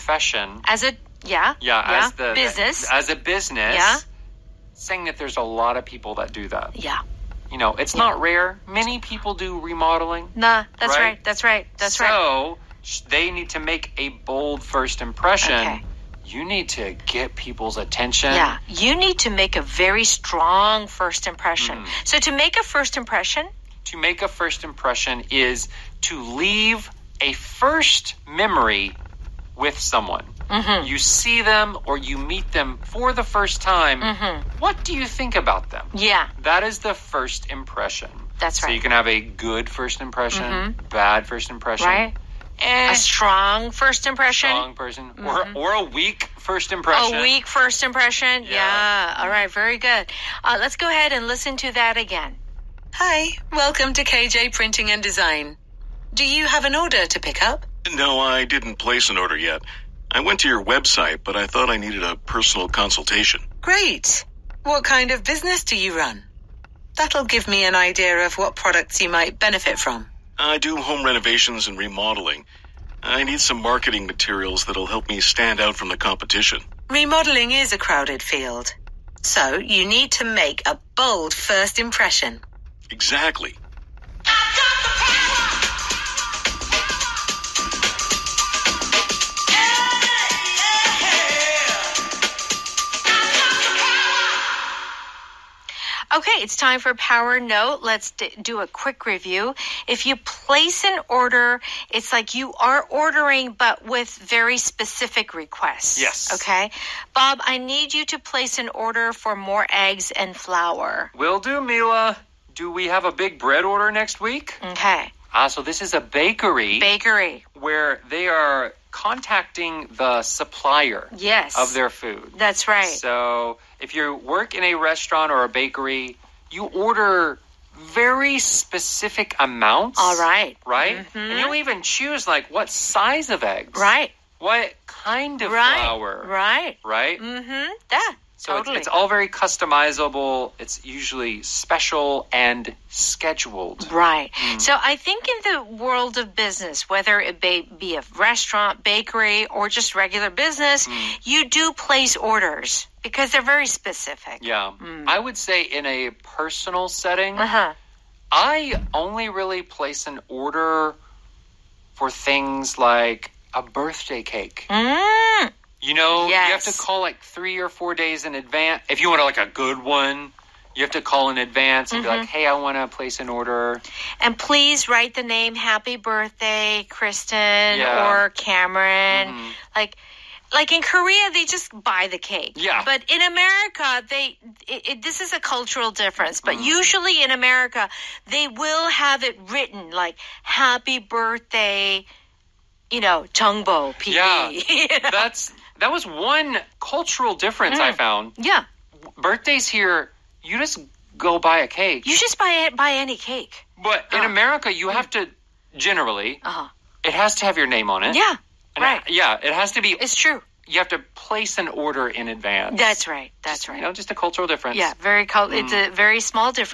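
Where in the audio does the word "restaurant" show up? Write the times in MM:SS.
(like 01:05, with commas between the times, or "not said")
02:04, 02:28.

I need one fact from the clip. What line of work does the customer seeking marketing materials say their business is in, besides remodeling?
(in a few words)
Home renovations.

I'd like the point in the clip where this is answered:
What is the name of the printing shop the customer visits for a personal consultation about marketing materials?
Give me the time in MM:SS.
00:54.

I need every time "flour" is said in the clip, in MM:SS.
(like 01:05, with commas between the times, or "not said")
01:50, 02:15.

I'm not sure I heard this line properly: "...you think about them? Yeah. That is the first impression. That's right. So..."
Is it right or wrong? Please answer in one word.
right.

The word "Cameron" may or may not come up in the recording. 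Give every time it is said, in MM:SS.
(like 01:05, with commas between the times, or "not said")
02:58.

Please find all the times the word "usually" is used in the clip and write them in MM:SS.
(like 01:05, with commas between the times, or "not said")
02:20, 03:06.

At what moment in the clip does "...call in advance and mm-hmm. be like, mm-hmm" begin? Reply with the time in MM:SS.
02:51.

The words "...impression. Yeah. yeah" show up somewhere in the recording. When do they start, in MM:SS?
00:47.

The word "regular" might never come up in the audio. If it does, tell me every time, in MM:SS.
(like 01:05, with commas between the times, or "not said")
02:29.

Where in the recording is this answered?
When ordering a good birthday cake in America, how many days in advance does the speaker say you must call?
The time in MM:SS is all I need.
02:47.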